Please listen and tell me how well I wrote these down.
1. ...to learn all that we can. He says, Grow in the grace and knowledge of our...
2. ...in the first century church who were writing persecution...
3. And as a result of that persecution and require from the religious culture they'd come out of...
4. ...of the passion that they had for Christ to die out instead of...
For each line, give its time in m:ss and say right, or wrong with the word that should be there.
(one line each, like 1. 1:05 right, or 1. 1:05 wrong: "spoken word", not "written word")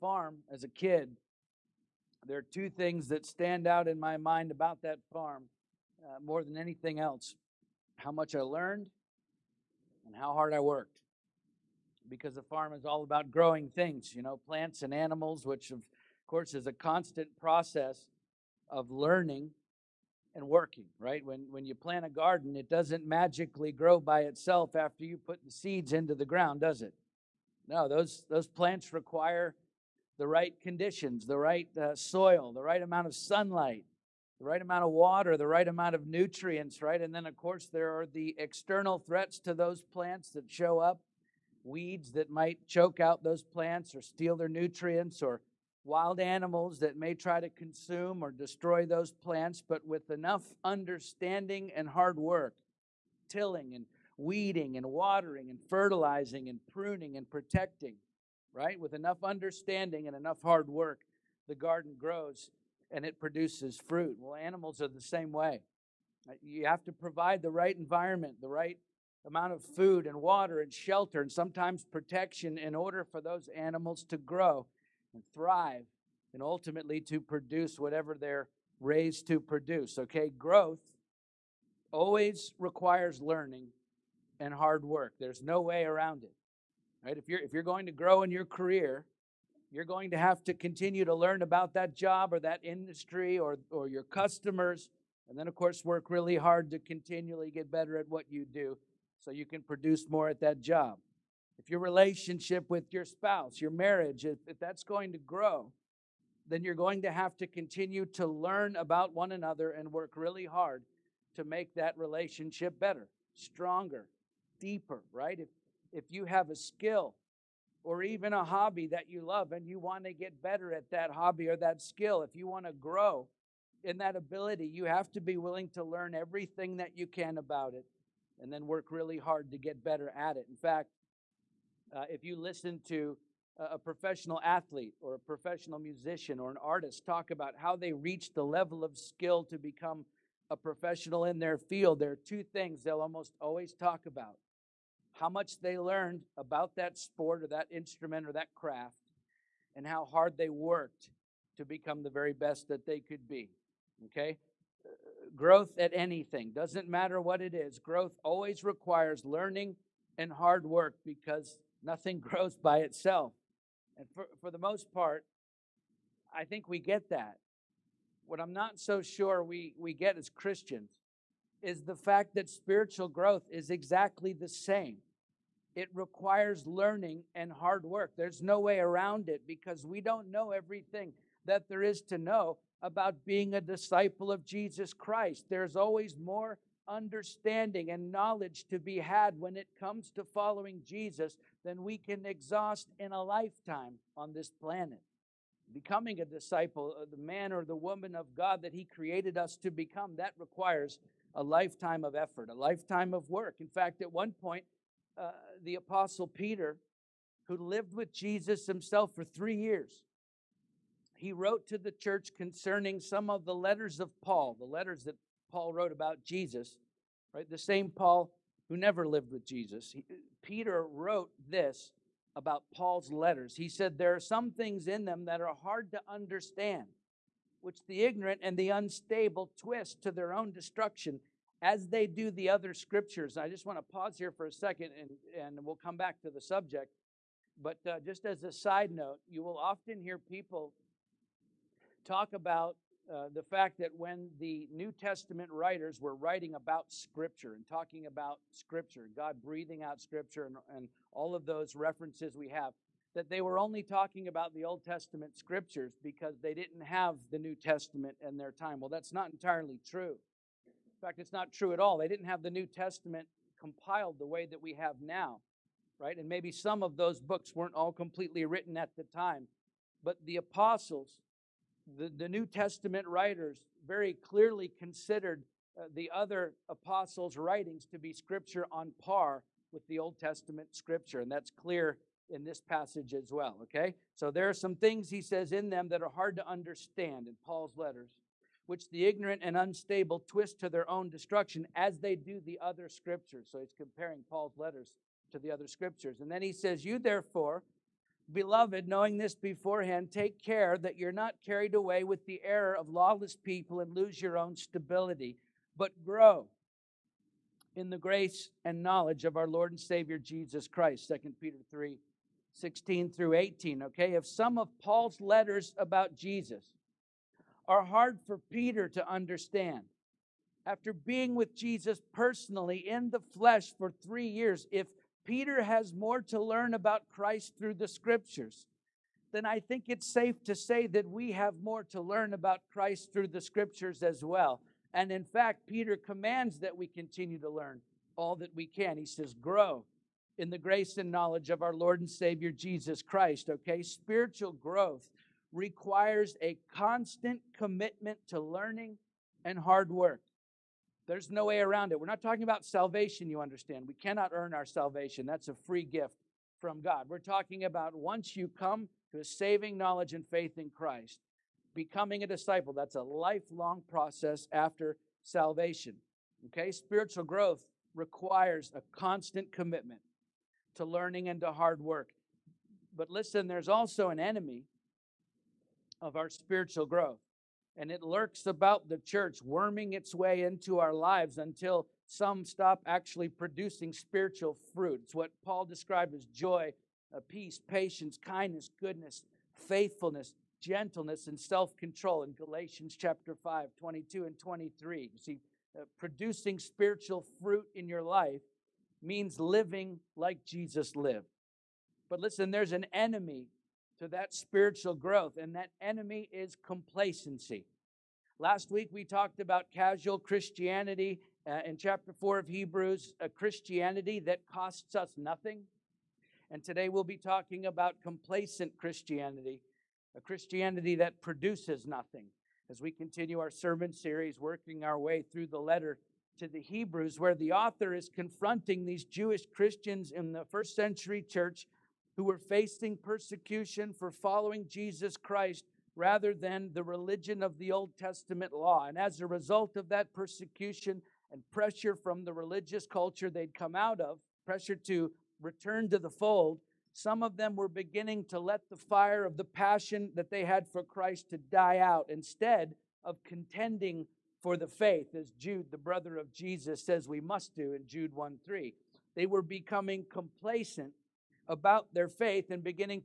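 1. 5:37 right
2. 7:10 wrong: "facing", not "writing"
3. 7:18 wrong: "pressure", not "require"
4. 7:29 right.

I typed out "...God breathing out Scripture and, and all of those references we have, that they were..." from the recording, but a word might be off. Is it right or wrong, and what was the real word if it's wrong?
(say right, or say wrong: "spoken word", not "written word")
right.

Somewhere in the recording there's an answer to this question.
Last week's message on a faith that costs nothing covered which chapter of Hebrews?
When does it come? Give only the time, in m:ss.
6:51.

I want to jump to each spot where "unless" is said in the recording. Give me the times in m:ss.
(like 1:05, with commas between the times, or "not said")
not said.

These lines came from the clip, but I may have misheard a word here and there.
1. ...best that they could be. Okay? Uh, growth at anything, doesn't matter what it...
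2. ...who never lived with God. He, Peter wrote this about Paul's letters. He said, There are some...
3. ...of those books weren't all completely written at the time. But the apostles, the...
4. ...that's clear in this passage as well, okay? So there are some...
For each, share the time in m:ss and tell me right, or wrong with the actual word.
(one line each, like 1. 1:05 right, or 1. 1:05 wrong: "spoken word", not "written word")
1. 2:32 right
2. 3:38 wrong: "Jesus", not "God"
3. 4:26 right
4. 4:41 right.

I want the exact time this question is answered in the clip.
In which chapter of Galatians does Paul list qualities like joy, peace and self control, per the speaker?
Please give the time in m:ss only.
6:32.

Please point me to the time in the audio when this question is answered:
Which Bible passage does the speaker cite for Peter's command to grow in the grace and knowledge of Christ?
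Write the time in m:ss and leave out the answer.
5:11.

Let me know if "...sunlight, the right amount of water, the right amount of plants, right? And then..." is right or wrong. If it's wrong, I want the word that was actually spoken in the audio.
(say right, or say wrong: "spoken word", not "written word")
wrong: "nutrients", not "plants".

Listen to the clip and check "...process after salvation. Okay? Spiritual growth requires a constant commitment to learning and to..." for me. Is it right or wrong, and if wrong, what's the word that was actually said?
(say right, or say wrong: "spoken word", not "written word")
right.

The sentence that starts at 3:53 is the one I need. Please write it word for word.
I just want to pause here for a second and, and we'll come back to the subject.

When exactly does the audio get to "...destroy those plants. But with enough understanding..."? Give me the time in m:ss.
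0:48.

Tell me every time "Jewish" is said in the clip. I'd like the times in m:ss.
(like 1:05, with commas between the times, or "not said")
7:09.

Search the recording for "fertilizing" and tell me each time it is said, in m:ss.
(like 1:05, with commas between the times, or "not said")
0:55.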